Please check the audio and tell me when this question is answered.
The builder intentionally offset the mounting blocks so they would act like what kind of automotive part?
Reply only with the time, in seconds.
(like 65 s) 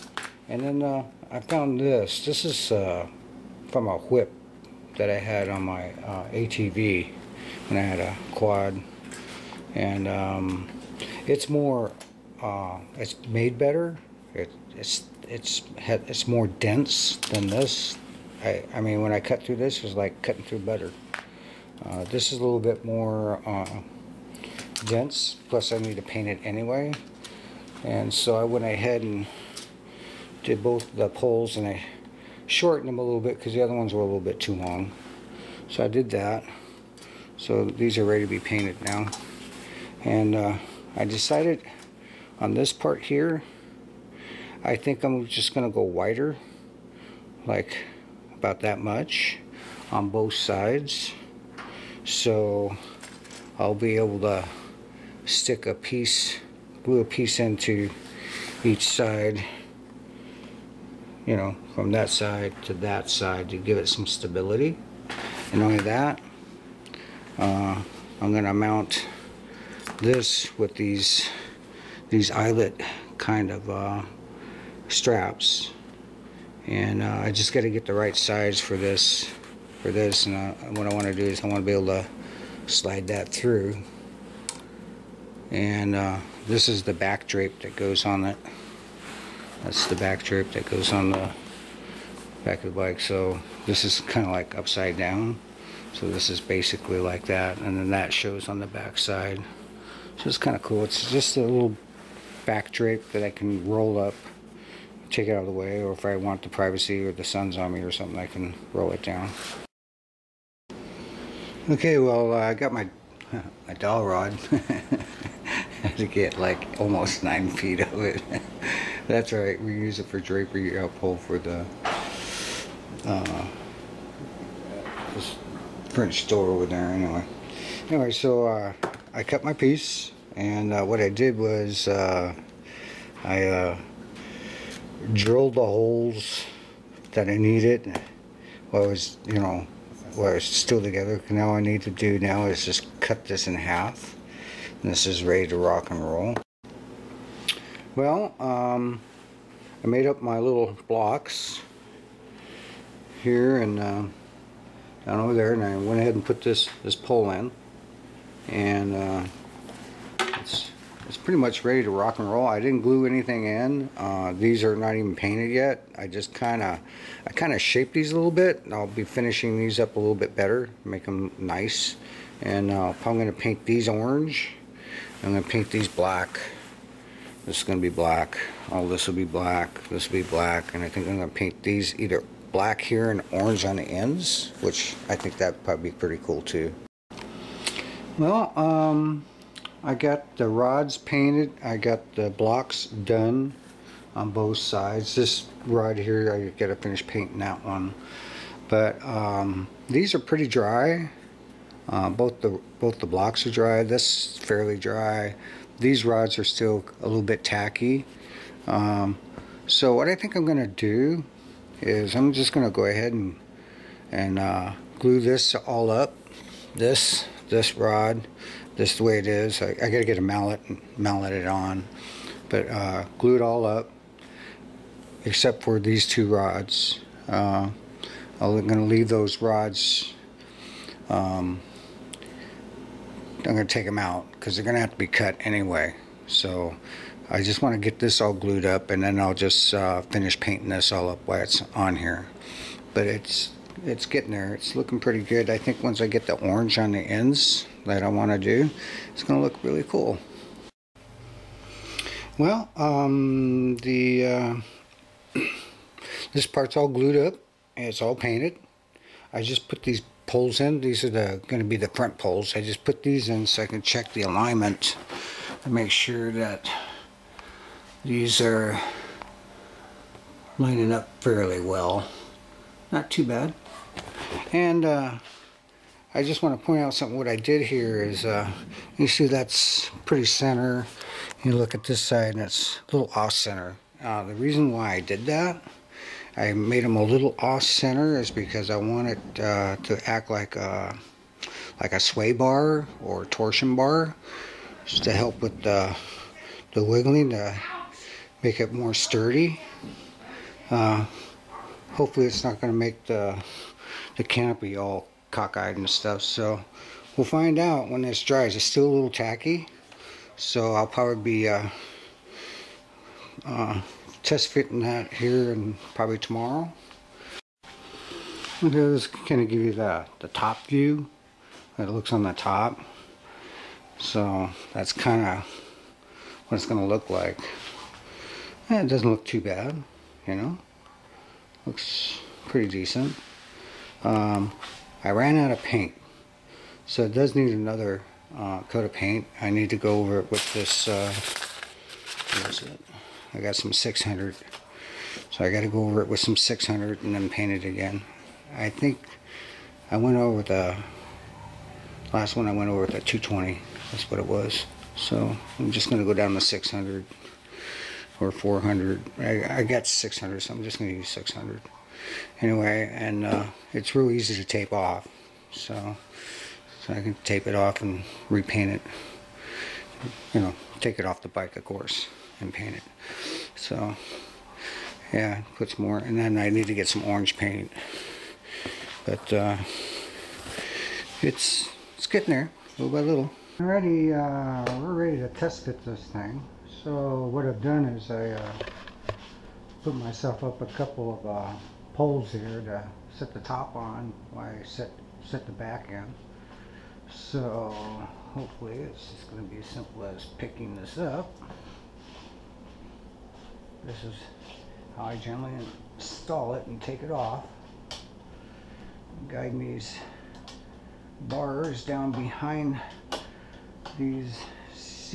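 291 s.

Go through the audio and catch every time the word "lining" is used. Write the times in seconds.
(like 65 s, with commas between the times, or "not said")
270 s.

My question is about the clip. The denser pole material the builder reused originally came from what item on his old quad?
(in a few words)
A whip.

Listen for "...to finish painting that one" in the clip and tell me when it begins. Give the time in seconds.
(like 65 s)
196 s.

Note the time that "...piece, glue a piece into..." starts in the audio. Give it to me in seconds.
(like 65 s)
55 s.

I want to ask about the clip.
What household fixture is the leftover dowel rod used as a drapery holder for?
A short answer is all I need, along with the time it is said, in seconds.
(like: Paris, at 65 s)
French door, at 125 s.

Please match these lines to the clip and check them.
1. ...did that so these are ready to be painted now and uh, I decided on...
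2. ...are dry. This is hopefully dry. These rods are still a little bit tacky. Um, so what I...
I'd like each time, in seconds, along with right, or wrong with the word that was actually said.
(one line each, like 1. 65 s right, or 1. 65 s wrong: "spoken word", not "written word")
1. 35 s right
2. 203 s wrong: "fairly", not "hopefully".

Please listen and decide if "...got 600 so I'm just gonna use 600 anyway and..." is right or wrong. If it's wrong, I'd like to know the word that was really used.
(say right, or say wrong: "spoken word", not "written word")
right.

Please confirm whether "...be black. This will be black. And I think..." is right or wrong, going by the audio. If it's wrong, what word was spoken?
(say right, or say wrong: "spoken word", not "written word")
right.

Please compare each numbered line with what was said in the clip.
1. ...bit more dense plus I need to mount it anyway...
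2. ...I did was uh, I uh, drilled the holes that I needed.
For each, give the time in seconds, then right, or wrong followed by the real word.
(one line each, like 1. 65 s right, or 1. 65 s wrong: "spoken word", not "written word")
1. 22 s wrong: "paint", not "mount"
2. 131 s right.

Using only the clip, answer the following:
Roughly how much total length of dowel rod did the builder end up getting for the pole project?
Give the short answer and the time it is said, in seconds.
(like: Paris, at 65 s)
Almost 9 feet, at 116 s.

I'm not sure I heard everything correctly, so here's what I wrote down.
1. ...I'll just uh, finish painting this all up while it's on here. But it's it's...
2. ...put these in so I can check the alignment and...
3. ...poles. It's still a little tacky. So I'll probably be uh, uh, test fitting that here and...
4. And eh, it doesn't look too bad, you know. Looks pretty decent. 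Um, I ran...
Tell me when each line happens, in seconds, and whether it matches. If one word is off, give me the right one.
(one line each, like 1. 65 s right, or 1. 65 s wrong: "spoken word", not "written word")
1. 239 s right
2. 262 s right
3. 308 s wrong: "dries", not "poles"
4. 328 s right.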